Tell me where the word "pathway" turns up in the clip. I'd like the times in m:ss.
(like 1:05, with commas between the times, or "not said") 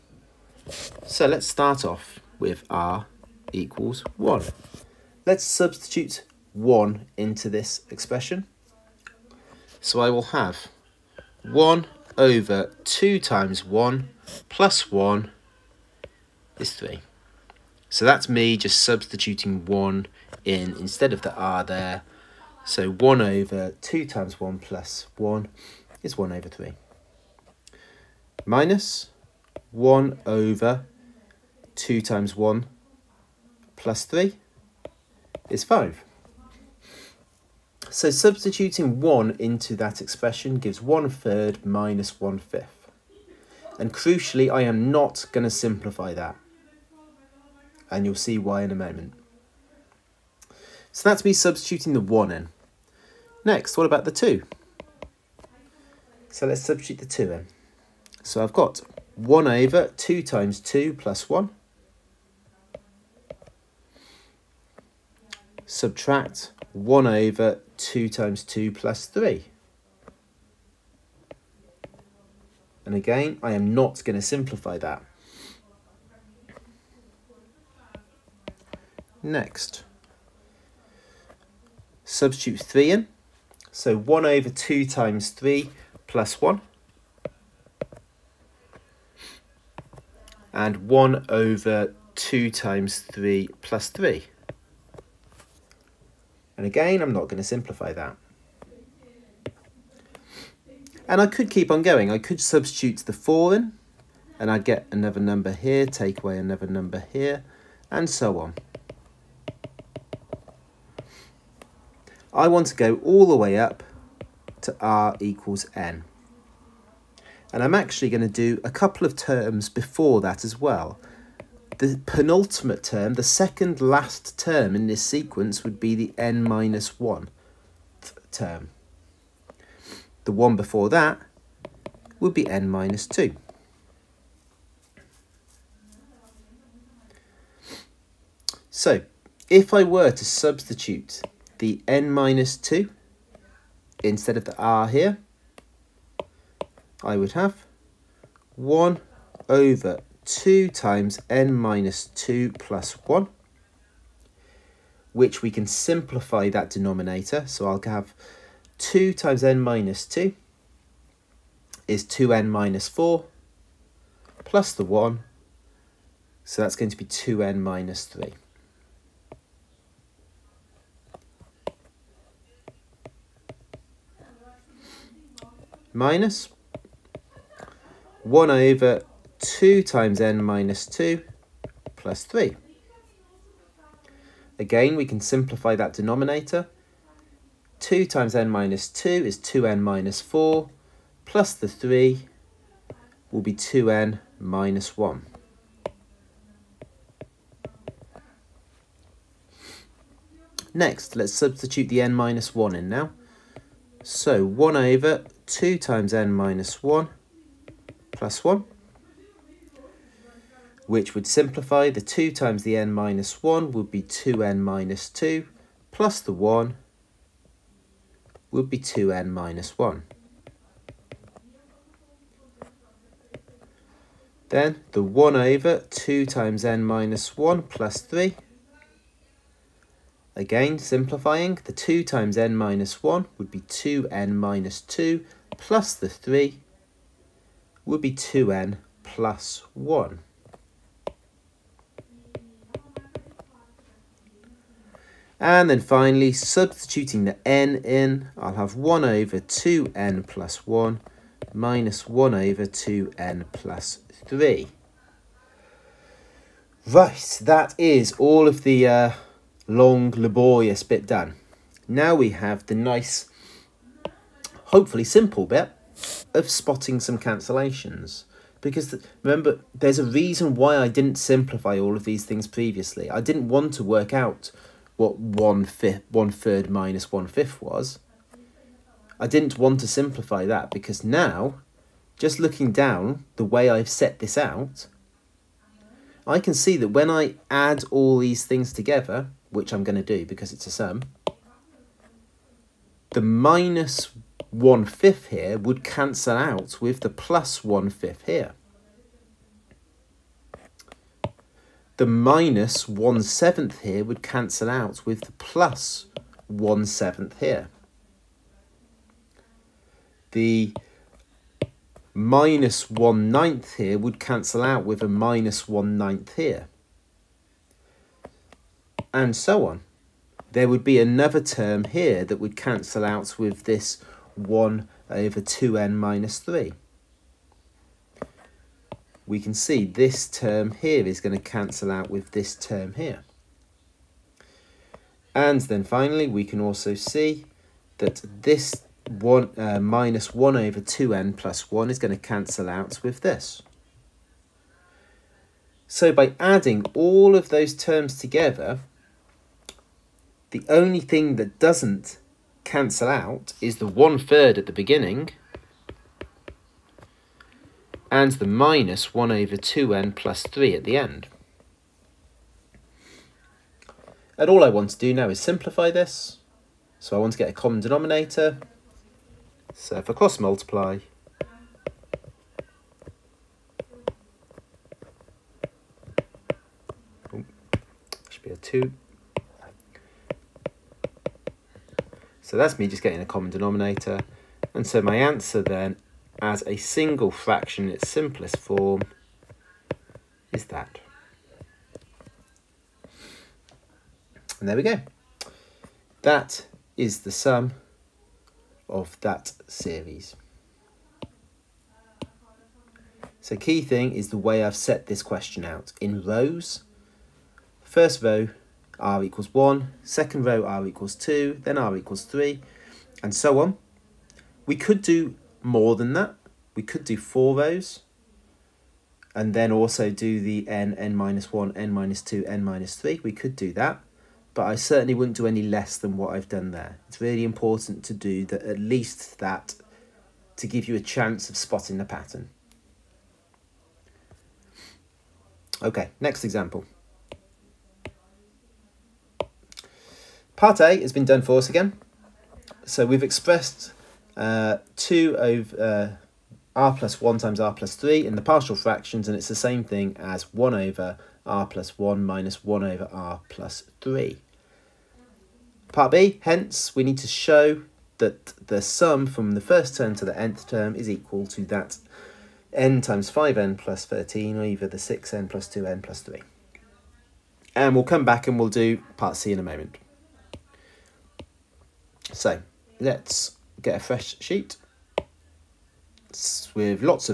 not said.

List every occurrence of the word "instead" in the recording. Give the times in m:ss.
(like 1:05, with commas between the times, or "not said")
0:20, 2:24.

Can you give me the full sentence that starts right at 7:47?
And we'll come back and we'll do part C in a moment.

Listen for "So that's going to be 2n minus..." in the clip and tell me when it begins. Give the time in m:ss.
2:46.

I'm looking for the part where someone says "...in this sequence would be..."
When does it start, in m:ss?
2:04.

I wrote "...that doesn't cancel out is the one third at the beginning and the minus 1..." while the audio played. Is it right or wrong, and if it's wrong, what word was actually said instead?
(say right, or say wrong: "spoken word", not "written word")
right.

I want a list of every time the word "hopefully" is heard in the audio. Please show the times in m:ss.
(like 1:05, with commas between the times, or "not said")
4:24.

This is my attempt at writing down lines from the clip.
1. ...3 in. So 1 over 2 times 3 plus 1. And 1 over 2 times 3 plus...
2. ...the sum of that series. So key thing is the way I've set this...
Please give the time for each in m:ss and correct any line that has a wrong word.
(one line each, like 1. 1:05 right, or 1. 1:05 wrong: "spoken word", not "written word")
1. 1:22 right
2. 6:37 right.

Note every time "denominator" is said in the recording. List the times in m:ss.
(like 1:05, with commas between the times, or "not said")
2:36, 3:05, 6:07, 6:23.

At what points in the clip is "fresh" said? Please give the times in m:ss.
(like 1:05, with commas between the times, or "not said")
7:53.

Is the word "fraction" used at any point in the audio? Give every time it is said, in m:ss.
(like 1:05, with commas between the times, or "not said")
6:27, 7:28.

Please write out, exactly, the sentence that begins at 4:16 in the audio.
Right, that is all of the uh, long, laborious bit done.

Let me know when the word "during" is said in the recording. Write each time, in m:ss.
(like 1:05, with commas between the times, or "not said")
not said.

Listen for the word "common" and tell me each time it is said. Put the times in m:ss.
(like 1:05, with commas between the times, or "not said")
6:07, 6:23.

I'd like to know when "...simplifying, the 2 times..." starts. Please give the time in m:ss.
3:50.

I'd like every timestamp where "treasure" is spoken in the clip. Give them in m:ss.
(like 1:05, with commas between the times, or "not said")
not said.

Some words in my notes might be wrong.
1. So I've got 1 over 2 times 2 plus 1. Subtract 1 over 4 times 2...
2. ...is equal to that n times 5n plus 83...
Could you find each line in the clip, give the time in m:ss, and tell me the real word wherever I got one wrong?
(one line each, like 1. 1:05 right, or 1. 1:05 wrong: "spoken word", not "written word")
1. 0:58 wrong: "2", not "4"
2. 7:40 wrong: "13", not "83".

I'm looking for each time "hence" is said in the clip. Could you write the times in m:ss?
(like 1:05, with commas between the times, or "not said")
7:36.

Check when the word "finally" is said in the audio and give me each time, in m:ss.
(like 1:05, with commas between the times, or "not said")
4:05, 5:35.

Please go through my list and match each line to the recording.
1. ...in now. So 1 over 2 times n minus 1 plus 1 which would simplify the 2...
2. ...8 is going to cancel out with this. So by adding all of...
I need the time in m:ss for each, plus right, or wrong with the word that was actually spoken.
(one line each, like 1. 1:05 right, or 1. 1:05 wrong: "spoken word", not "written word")
1. 3:22 right
2. 5:41 wrong: "1", not "8".